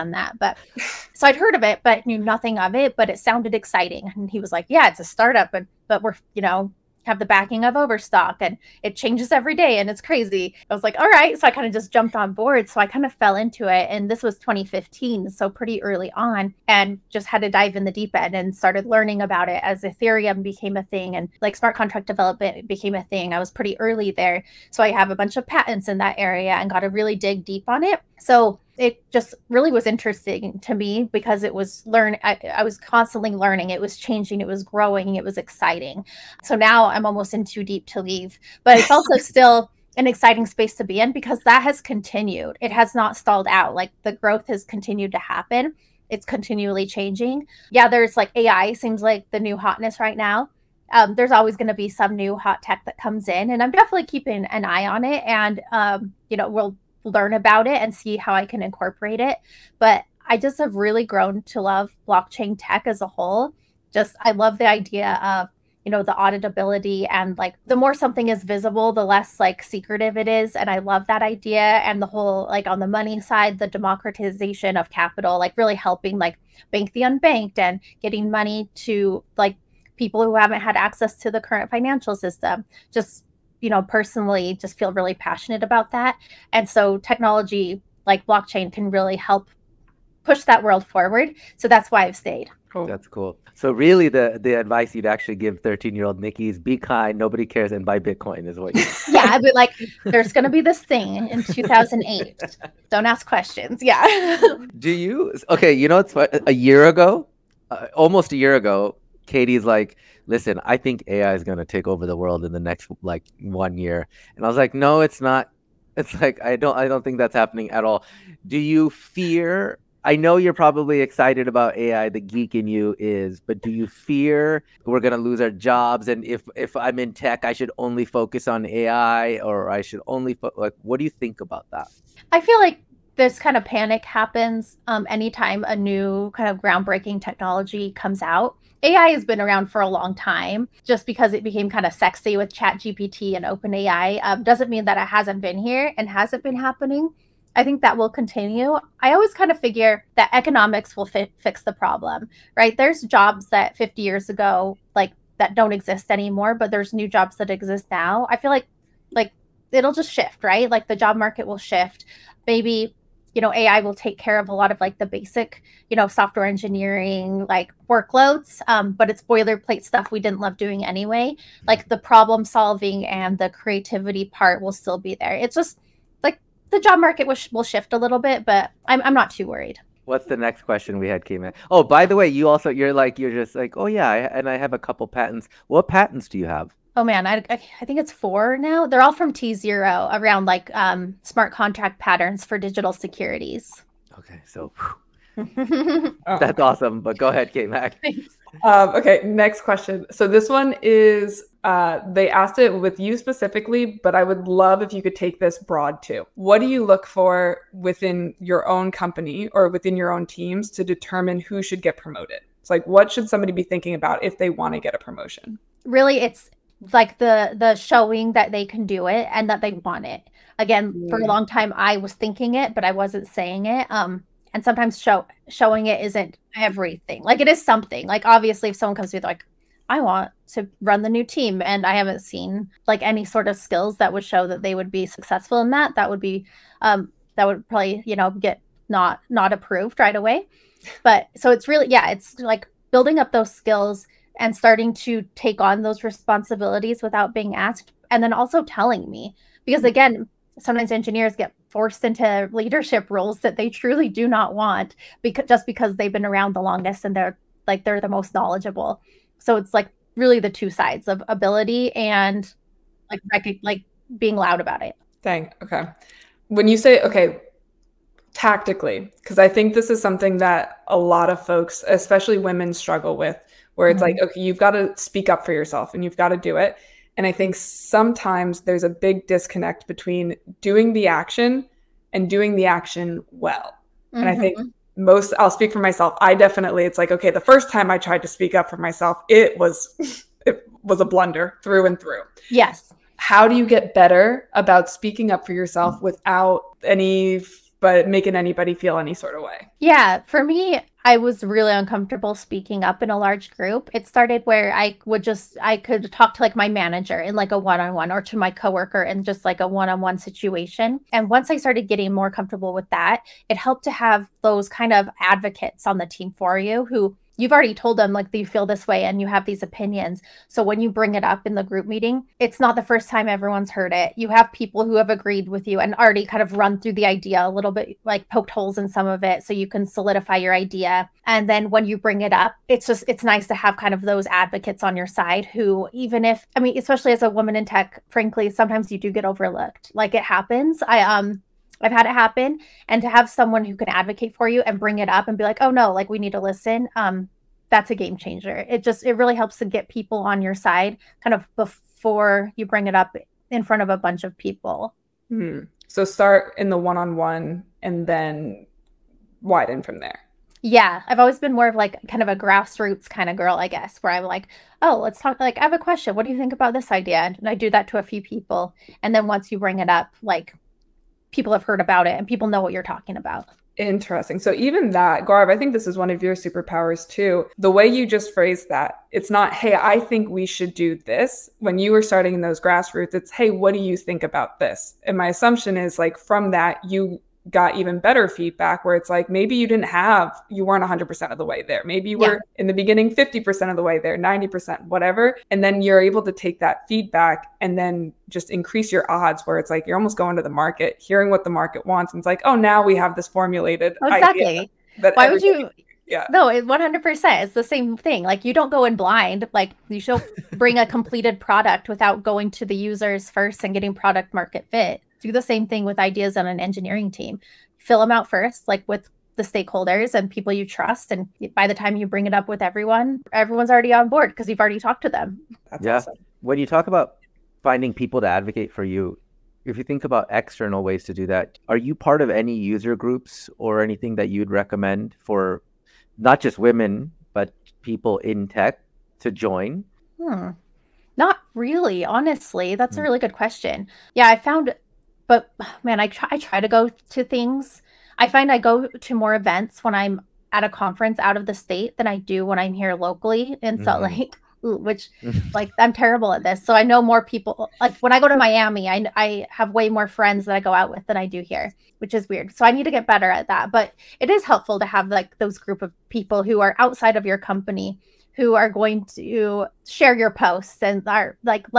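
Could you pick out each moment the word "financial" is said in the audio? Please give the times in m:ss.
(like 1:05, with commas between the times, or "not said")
1:21.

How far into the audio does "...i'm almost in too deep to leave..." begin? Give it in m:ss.
0:36.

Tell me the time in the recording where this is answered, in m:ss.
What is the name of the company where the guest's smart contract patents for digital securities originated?
3:09.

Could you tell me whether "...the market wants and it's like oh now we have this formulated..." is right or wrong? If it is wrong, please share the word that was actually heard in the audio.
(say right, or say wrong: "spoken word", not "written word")
right.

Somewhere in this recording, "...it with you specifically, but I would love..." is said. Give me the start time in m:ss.
3:22.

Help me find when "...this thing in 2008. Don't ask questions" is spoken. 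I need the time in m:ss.
1:40.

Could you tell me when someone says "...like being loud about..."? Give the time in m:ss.
4:23.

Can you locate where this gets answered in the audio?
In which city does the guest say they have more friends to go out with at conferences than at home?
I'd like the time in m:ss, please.
7:38.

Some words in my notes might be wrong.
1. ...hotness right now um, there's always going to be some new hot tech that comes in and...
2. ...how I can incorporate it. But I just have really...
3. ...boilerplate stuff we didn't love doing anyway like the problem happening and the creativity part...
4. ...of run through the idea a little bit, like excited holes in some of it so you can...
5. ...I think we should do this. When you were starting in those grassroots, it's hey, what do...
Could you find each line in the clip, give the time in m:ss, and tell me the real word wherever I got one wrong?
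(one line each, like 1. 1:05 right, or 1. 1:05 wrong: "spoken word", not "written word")
1. 0:49 right
2. 0:58 right
3. 2:49 wrong: "solving", not "happening"
4. 5:26 wrong: "poked", not "excited"
5. 6:19 right.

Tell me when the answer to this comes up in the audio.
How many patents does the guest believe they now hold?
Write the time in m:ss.
3:08.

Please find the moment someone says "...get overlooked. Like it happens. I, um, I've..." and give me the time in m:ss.
5:39.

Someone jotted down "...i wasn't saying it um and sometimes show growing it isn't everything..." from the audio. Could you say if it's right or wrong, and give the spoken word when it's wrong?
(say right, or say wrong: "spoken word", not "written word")
wrong: "showing", not "growing".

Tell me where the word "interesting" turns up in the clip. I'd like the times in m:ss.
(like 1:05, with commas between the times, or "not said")
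0:29, 6:13.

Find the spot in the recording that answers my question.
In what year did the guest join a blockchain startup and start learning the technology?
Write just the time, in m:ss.
0:14.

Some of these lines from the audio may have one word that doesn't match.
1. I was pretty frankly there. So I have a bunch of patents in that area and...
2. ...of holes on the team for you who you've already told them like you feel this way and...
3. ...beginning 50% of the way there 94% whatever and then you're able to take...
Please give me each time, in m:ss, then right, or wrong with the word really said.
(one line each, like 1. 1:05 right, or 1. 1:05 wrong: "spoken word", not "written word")
1. 0:23 wrong: "early", not "frankly"
2. 5:14 wrong: "advocates", not "holes"
3. 6:32 wrong: "90", not "94".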